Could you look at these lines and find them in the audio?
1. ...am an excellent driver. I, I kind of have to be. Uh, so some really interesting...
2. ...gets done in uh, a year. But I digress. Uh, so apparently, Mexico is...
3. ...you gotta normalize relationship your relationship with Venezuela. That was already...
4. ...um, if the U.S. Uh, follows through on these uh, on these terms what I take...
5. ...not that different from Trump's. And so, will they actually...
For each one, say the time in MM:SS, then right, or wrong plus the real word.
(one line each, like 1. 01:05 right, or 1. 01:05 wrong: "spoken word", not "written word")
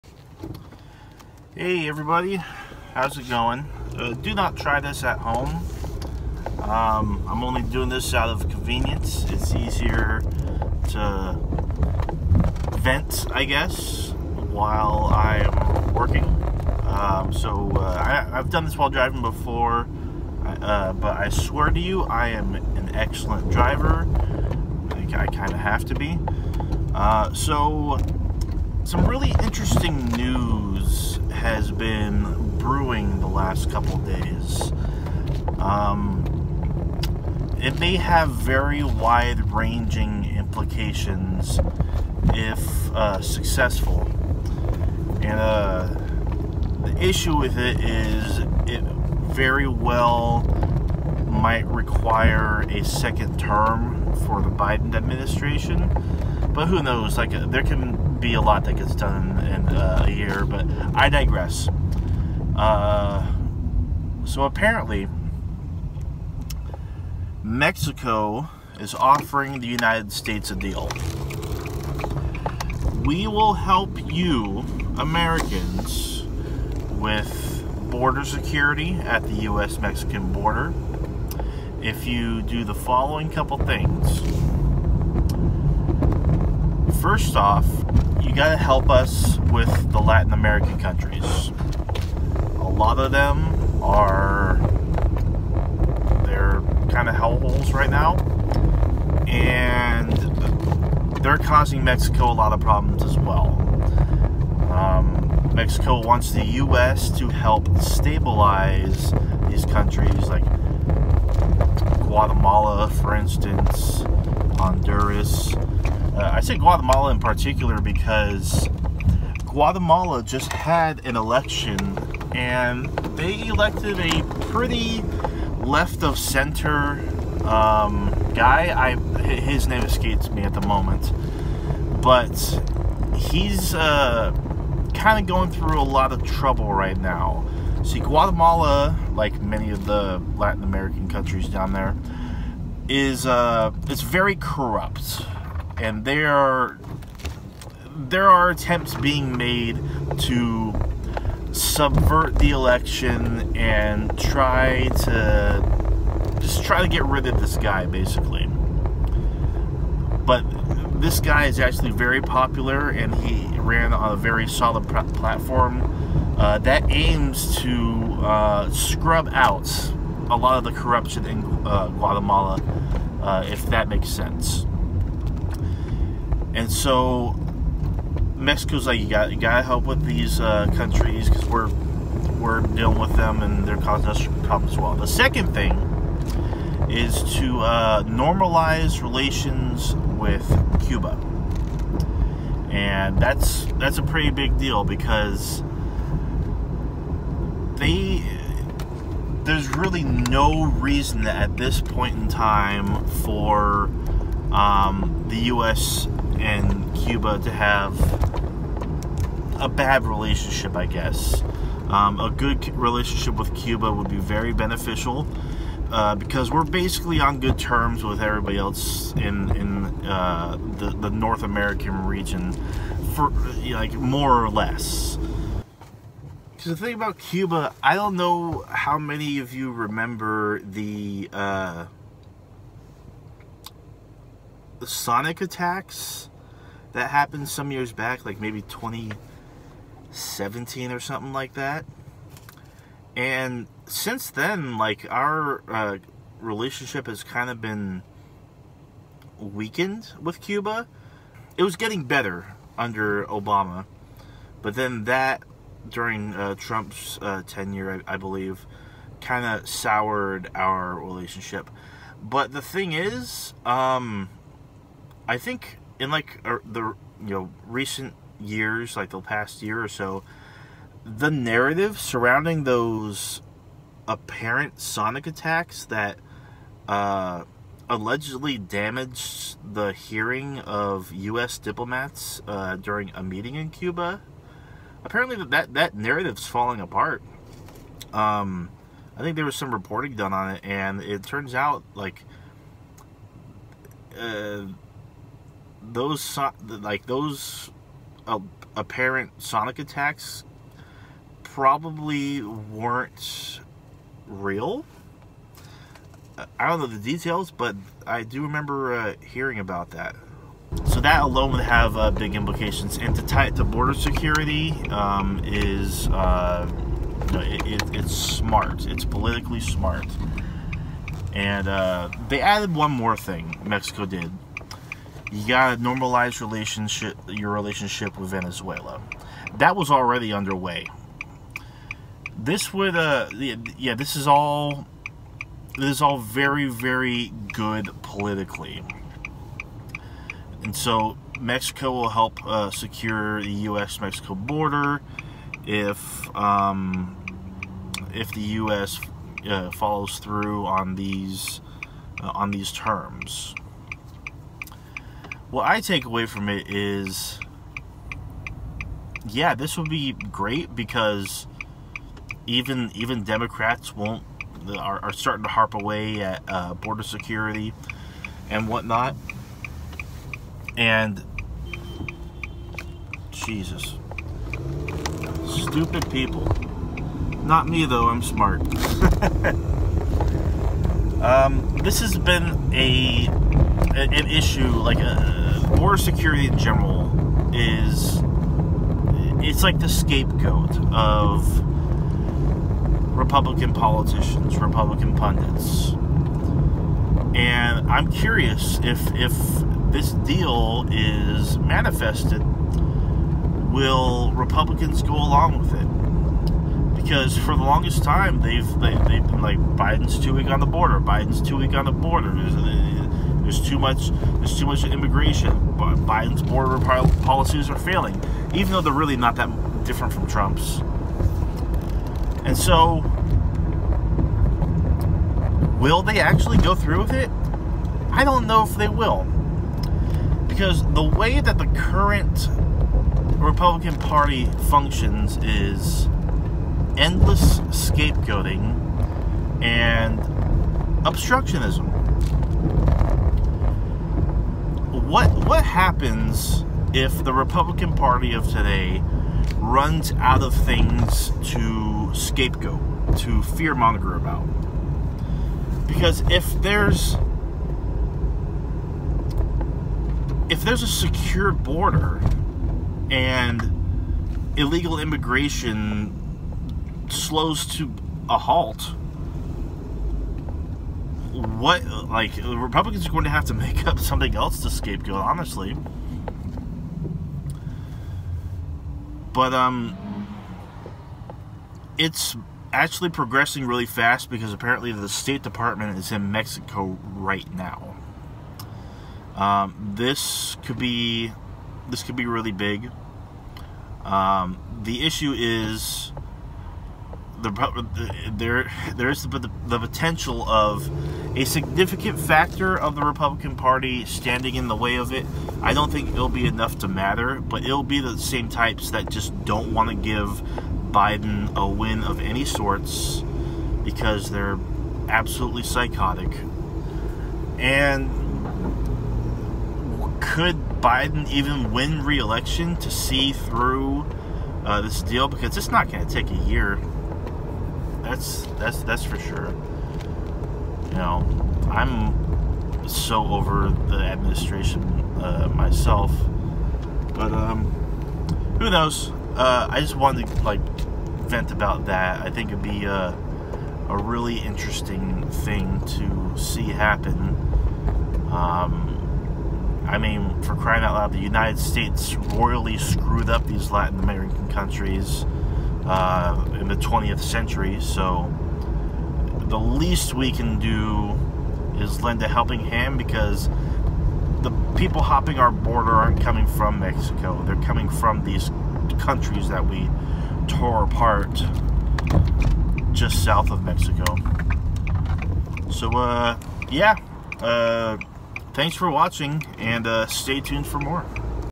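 1. 00:22 right
2. 00:58 right
3. 05:25 right
4. 05:46 right
5. 06:59 right.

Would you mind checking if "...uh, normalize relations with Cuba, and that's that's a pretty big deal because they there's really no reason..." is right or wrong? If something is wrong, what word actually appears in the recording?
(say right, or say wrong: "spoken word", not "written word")
right.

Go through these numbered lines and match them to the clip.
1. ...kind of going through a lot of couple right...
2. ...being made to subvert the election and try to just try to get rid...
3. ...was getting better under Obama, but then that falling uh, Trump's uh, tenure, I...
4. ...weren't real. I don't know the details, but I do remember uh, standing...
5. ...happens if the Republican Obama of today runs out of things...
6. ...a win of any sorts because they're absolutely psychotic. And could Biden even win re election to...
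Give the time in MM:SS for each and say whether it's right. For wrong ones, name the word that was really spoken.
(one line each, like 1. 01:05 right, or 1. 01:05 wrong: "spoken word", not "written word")
1. 02:14 wrong: "trouble", not "couple"
2. 02:28 right
3. 04:11 wrong: "during", not "falling"
4. 05:02 wrong: "hearing", not "standing"
5. 07:25 wrong: "Party", not "Obama"
6. 08:31 right.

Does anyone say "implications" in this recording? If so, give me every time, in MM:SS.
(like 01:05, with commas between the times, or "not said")
00:40, 05:12.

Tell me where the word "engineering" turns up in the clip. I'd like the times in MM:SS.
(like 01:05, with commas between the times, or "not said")
not said.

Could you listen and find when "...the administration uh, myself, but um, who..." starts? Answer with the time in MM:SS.
08:53.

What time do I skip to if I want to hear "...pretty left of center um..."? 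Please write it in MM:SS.
02:04.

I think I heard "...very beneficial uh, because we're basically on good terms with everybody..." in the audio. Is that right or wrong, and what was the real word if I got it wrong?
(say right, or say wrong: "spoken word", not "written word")
right.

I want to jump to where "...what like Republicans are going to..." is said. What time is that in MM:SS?
07:51.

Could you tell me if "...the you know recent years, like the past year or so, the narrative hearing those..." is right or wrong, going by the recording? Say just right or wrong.
wrong.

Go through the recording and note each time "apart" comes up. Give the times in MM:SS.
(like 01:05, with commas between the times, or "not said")
04:46, 09:30.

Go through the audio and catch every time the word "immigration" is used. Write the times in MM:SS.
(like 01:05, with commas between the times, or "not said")
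06:54, 07:44.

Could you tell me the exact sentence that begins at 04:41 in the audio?
diplomats uh, during a meeting in Cuba.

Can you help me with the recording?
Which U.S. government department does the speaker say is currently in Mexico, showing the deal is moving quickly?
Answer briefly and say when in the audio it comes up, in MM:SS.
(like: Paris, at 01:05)
State Department, at 08:05.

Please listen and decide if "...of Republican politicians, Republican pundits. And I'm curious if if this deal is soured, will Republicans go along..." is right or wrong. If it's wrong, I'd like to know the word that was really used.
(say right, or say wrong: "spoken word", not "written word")
wrong: "manifested", not "soured".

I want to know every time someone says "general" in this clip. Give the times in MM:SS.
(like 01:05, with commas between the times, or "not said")
06:26.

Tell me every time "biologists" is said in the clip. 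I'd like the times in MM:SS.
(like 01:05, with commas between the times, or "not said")
not said.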